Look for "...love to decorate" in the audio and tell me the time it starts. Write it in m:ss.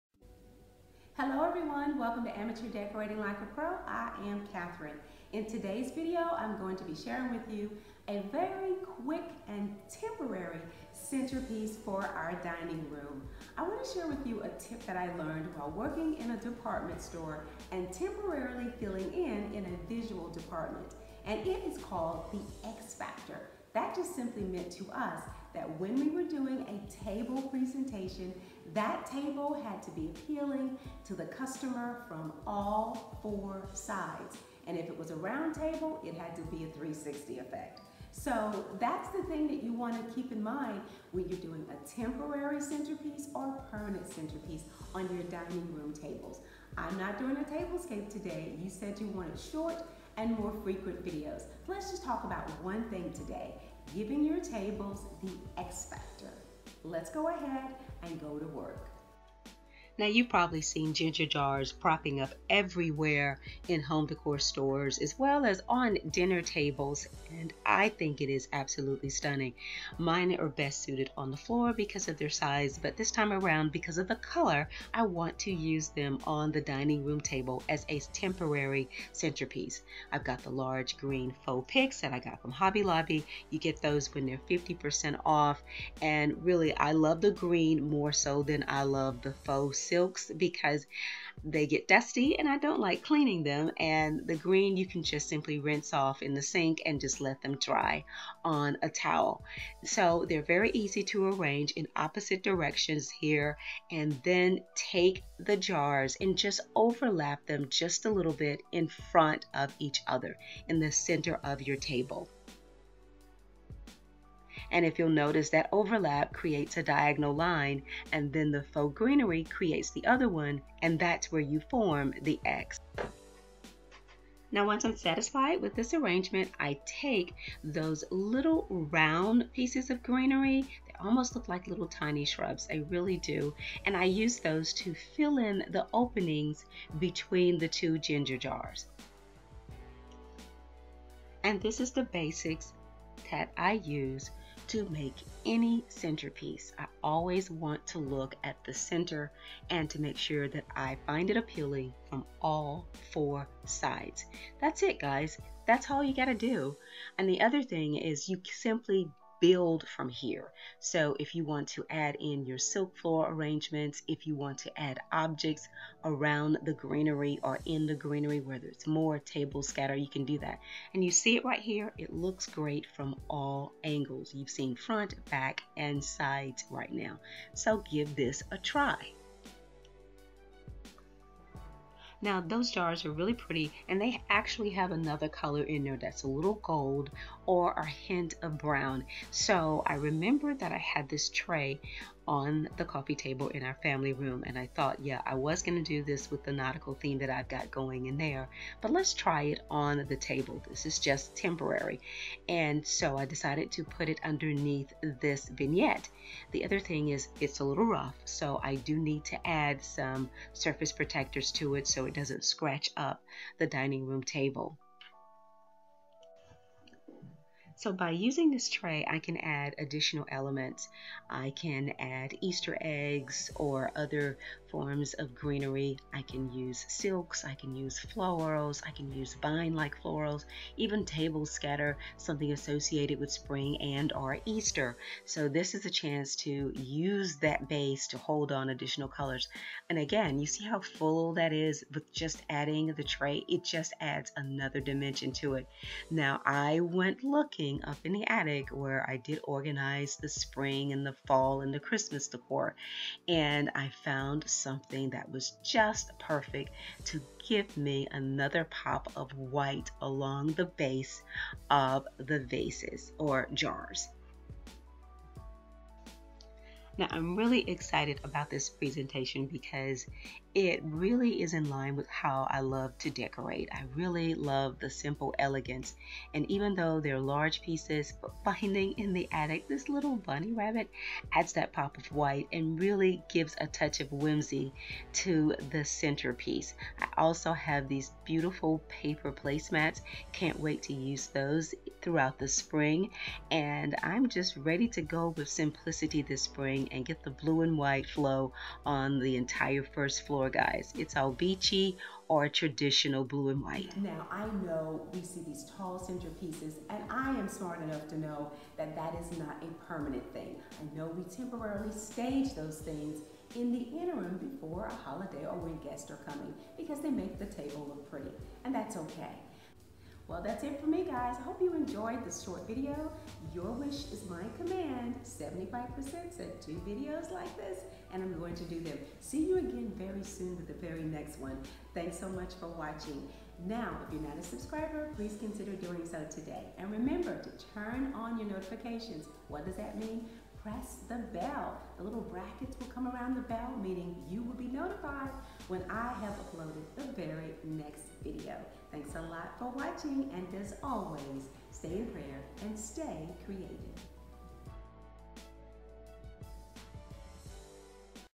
4:32.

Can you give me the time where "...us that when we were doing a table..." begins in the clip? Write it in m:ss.
0:24.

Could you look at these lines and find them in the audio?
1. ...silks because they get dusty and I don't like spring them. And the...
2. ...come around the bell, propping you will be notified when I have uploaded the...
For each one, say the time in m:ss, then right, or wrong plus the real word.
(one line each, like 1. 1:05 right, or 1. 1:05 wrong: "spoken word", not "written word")
1. 1:29 wrong: "cleaning", not "spring"
2. 5:42 wrong: "meaning", not "propping".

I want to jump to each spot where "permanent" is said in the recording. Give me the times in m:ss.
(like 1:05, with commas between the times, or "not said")
0:43, 5:09.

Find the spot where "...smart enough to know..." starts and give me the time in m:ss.
5:07.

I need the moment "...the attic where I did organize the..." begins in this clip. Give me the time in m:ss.
4:08.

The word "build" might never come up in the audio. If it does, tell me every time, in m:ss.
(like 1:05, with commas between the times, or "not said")
2:39.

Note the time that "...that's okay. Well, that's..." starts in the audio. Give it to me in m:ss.
5:18.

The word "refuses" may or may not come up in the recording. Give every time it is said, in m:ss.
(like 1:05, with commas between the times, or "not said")
not said.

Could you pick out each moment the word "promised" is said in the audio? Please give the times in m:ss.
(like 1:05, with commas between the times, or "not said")
not said.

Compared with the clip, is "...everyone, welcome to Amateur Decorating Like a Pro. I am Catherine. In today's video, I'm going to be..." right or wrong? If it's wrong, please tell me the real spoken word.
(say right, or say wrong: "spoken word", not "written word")
right.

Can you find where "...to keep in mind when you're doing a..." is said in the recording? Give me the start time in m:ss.
0:39.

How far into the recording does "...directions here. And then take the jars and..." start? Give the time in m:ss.
1:42.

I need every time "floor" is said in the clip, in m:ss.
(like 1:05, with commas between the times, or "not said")
1:11, 2:42, 5:00.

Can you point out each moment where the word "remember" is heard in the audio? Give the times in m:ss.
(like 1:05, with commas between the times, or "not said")
3:09, 5:36.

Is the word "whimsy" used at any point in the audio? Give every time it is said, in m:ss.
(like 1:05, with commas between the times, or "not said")
4:44.